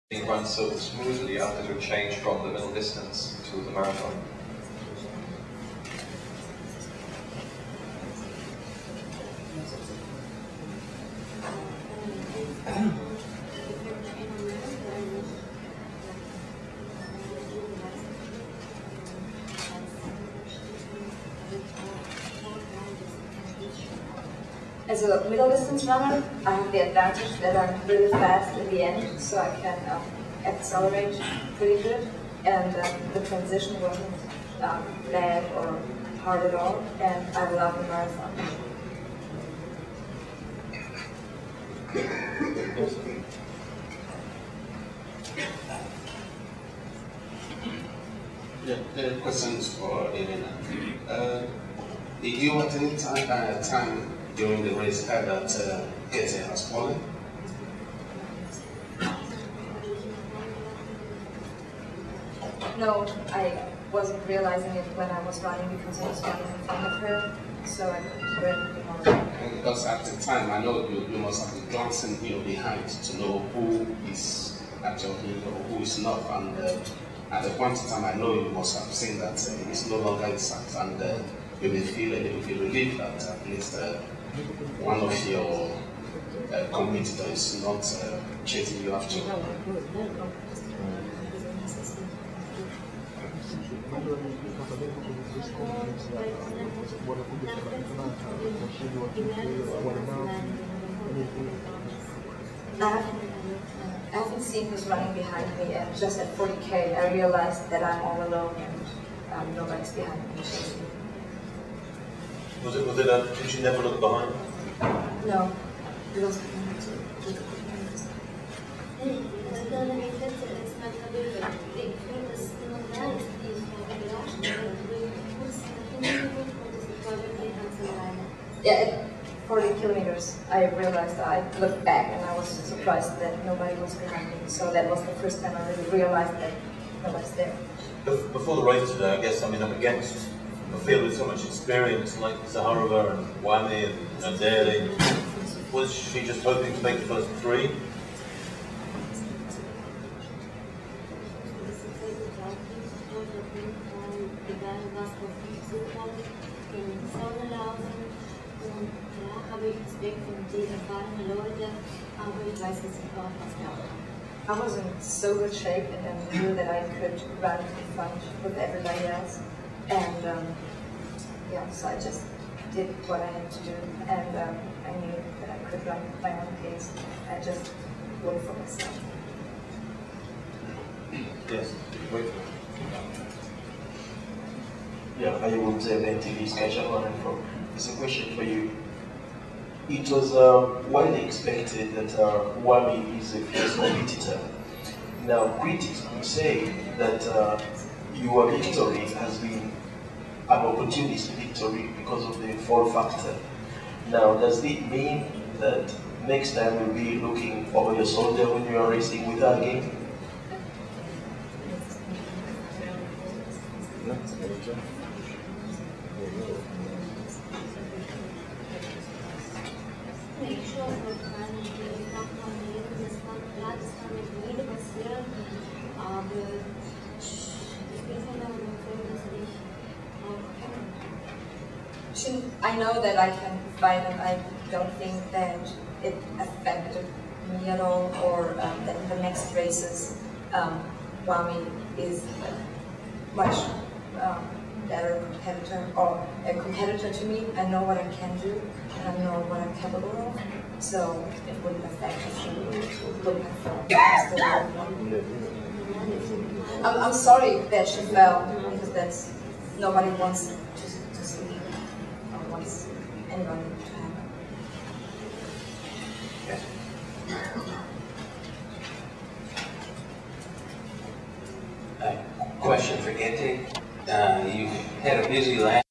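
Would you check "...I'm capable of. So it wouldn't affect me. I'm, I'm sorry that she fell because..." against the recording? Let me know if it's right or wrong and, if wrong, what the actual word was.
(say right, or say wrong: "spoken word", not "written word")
right.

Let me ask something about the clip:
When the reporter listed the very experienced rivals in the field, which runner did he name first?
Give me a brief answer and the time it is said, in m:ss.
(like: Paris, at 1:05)
Zakharova, at 2:22.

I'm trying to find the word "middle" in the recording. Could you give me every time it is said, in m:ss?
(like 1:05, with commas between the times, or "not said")
0:02, 0:25.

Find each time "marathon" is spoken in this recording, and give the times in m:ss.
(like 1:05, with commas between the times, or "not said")
0:03, 0:37.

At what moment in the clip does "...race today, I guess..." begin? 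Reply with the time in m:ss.
2:18.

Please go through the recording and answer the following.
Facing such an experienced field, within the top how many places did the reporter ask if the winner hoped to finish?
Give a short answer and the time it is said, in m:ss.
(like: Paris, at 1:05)
3, at 2:27.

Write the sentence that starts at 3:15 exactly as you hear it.
Now, critics could say that uh, your victory has been an opportunist victory because of the fall factor.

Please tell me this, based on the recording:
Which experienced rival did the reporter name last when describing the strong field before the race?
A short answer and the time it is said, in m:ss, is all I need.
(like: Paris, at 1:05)
Naderi, at 2:24.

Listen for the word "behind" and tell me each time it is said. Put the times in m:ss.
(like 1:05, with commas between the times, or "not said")
1:12, 1:45, 1:49, 1:53, 2:13.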